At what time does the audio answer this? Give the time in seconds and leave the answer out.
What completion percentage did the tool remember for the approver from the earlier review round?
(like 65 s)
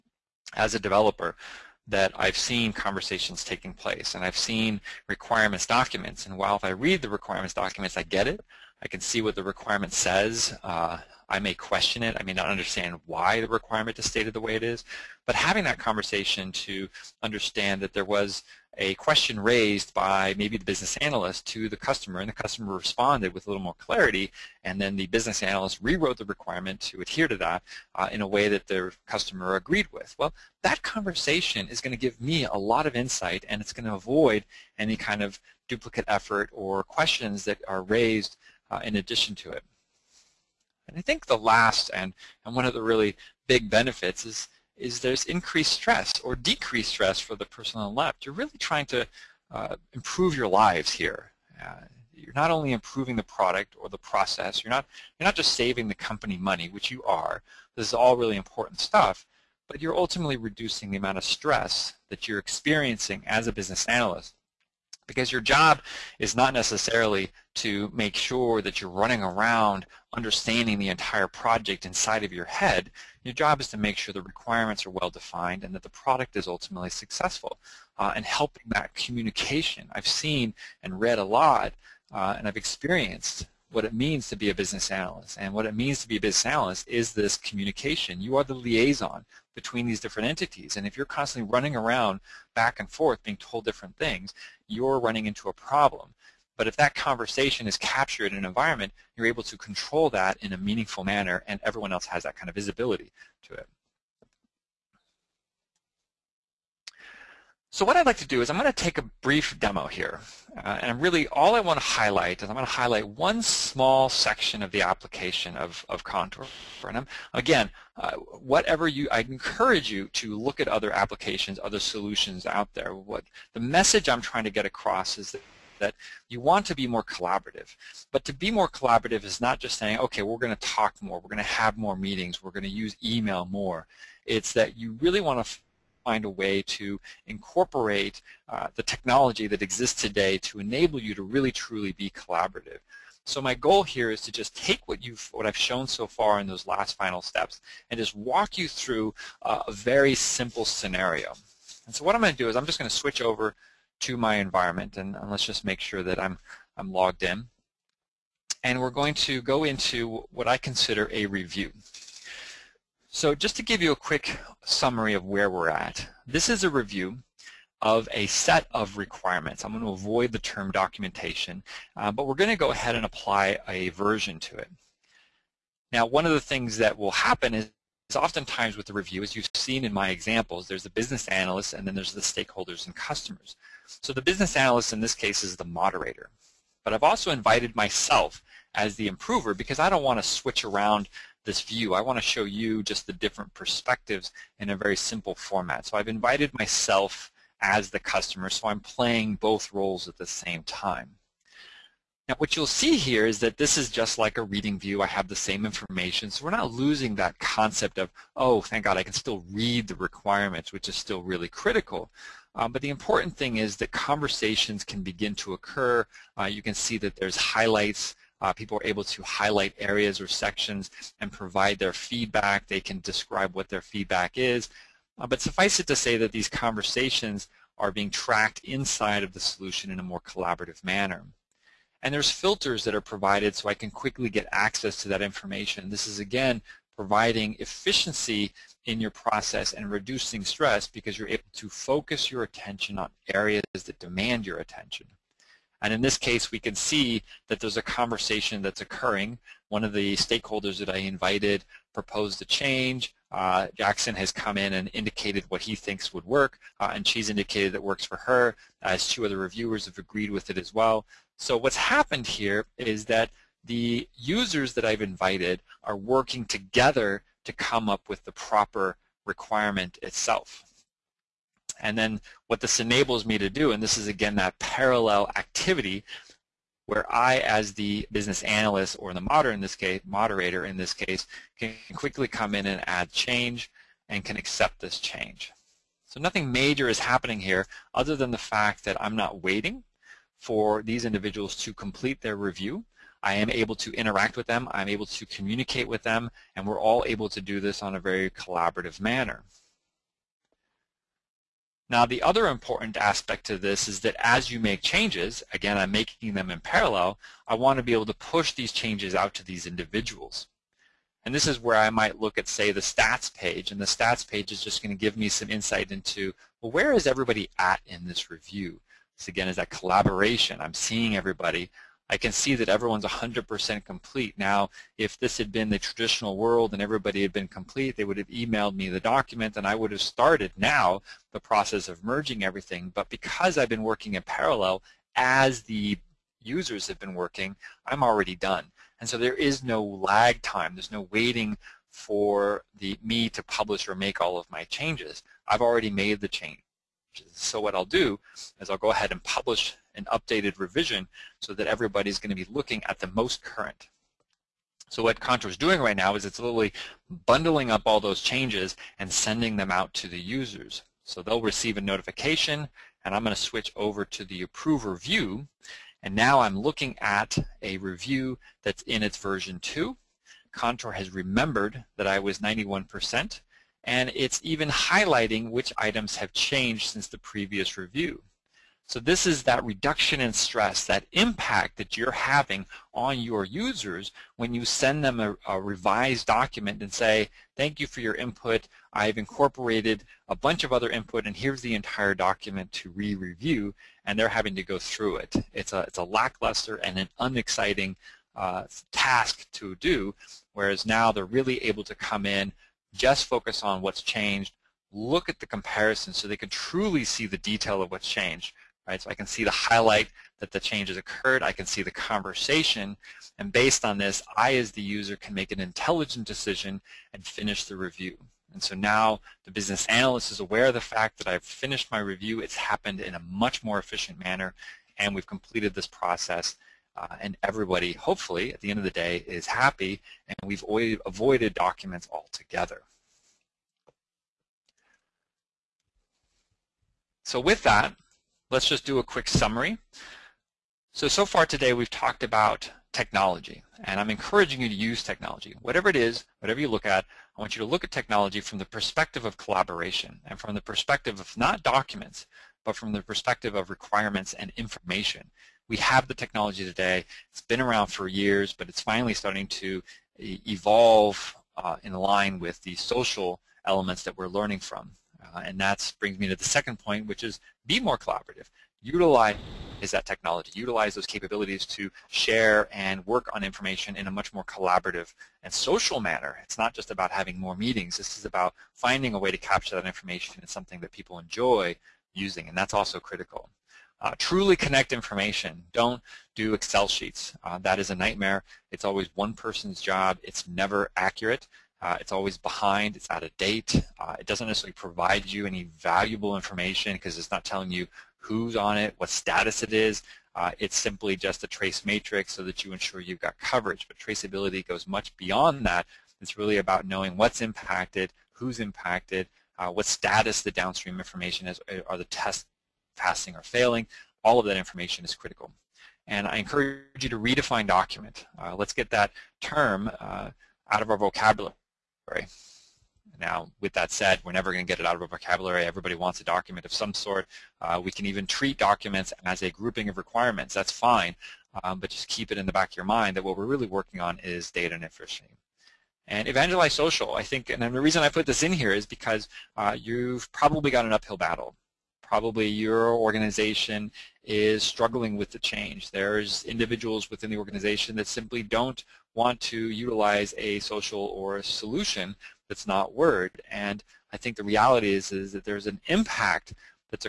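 372 s.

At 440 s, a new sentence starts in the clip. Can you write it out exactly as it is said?
So, so far today we've talked about technology, and I'm encouraging you to use technology.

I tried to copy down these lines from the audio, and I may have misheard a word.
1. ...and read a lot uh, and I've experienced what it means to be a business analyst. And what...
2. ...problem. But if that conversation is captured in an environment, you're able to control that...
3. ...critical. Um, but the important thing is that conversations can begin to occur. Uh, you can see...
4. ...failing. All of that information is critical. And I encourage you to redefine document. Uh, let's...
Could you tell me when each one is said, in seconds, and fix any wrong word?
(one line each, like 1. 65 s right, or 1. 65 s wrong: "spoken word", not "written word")
1. 80 s right
2. 95 s right
3. 211 s right
4. 513 s right.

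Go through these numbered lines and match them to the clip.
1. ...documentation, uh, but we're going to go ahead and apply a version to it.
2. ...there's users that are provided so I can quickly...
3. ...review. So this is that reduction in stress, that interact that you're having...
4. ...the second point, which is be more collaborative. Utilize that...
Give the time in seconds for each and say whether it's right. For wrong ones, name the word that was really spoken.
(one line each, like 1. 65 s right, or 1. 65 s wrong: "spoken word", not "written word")
1. 170 s right
2. 232 s wrong: "filters", not "users"
3. 377 s wrong: "impact", not "interact"
4. 466 s right.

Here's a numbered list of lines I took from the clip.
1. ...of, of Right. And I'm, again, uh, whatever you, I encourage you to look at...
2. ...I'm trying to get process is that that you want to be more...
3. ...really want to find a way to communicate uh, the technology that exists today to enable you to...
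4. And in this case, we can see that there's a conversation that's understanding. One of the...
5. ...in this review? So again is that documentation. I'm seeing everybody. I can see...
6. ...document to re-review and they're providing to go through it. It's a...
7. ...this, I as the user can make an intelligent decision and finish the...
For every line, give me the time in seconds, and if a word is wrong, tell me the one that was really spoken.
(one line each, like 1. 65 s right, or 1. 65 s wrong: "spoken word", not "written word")
1. 115 s wrong: "Contour", not "Right"
2. 124 s wrong: "across", not "process"
3. 134 s wrong: "incorporate", not "communicate"
4. 245 s wrong: "occurring", not "understanding"
5. 317 s wrong: "collaboration", not "documentation"
6. 392 s wrong: "having", not "providing"
7. 413 s right.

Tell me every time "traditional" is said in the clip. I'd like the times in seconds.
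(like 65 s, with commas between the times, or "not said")
325 s.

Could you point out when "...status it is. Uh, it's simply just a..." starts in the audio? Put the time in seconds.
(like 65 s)
499 s.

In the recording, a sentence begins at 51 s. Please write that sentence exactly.
Uh, you're not only improving the product or the process, you're not, you're not just saving the company money, which you are.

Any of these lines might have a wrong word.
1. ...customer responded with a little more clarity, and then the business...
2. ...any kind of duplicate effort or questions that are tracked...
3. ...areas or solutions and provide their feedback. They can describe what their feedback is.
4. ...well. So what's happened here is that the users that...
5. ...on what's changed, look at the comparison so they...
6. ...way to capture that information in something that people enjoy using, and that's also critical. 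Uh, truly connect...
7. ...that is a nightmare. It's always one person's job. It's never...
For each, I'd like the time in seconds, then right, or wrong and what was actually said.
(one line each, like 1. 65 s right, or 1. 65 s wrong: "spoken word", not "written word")
1. 22 s right
2. 34 s wrong: "raised", not "tracked"
3. 219 s wrong: "sections", not "solutions"
4. 260 s right
5. 403 s right
6. 479 s right
7. 487 s right.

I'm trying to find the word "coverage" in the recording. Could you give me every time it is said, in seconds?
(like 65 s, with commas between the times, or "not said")
503 s.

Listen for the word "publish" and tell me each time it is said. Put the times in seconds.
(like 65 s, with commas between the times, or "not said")
343 s, 349 s.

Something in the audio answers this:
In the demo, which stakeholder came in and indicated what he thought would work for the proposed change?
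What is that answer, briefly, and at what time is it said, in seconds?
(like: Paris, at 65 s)
Jackson, at 253 s.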